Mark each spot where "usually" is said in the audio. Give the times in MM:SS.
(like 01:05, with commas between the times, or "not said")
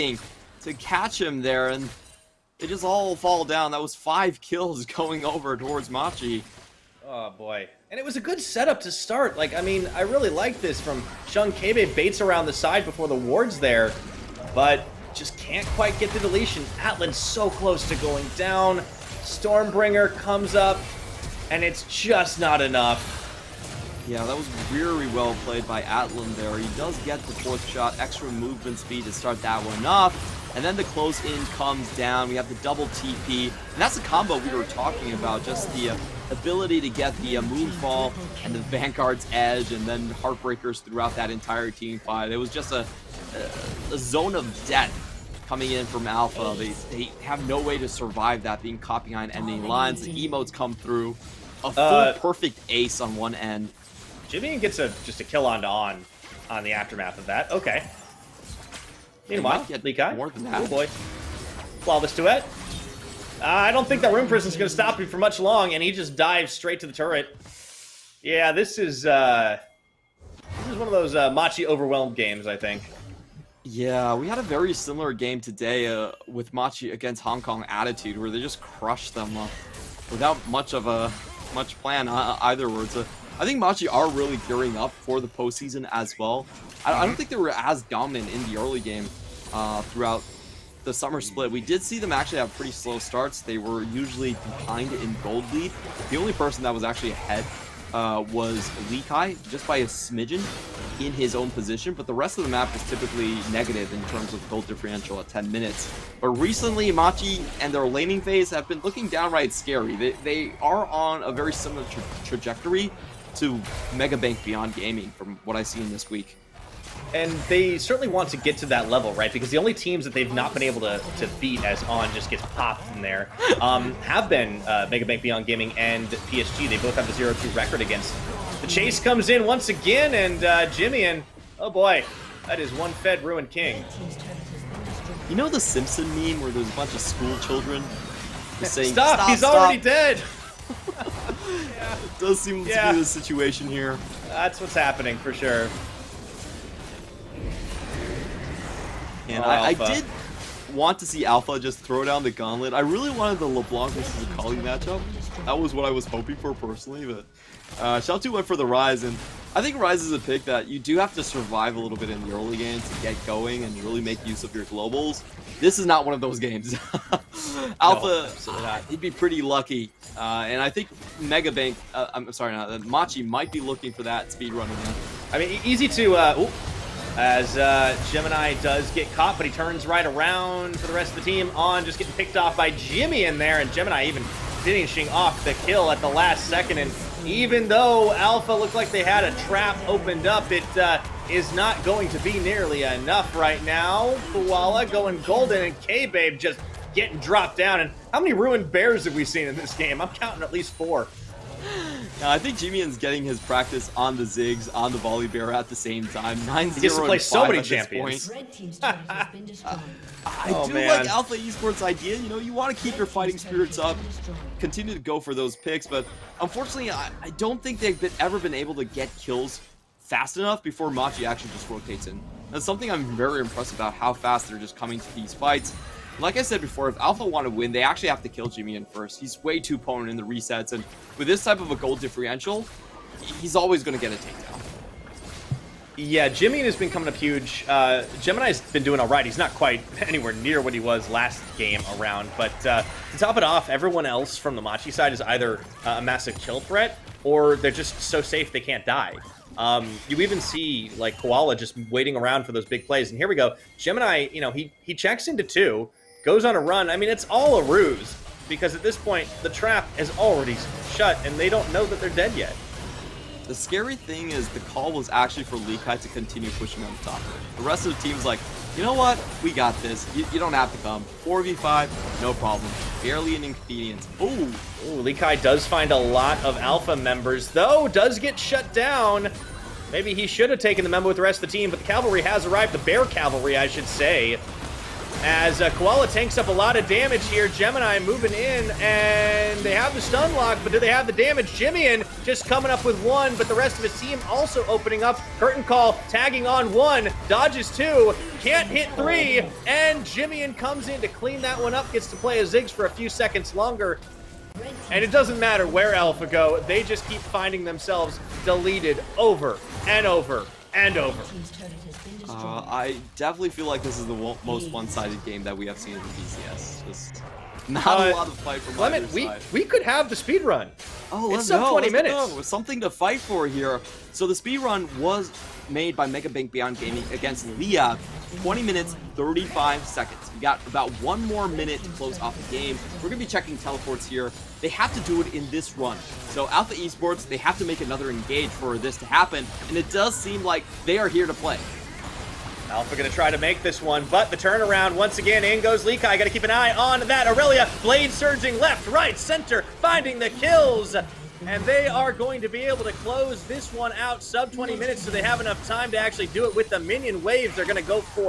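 01:33.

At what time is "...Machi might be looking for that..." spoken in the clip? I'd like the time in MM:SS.
02:52.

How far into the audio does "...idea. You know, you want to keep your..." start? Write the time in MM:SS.
03:31.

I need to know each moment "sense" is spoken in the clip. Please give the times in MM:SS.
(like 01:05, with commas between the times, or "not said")
not said.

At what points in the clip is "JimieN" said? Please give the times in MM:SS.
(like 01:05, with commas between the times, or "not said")
03:22, 04:51, 05:00.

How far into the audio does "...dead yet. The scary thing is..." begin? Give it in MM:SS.
04:22.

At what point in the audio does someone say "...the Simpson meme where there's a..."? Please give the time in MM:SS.
02:15.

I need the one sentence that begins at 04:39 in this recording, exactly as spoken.
Maybe he should have taken the memo with the rest of the team, but the cavalry has arrived.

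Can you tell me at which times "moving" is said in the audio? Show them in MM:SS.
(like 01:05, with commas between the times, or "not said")
04:47.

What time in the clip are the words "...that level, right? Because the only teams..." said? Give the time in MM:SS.
01:58.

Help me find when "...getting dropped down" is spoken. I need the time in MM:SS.
03:16.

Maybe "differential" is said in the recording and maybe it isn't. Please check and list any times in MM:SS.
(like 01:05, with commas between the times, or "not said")
01:44, 03:52.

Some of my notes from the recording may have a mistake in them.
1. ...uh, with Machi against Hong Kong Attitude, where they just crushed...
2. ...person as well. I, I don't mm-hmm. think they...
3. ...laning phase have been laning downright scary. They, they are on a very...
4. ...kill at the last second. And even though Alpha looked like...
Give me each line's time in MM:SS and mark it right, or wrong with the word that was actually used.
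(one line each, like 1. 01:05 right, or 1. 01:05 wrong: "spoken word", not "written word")
1. 01:15 right
2. 01:25 wrong: "postseason", not "person"
3. 01:47 wrong: "looking", not "laning"
4. 03:05 right.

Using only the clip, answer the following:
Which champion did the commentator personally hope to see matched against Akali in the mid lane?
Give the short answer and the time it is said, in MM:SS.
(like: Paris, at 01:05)
LeBlanc, at 02:33.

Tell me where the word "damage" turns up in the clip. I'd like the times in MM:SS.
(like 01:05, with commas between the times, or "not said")
04:46, 04:51.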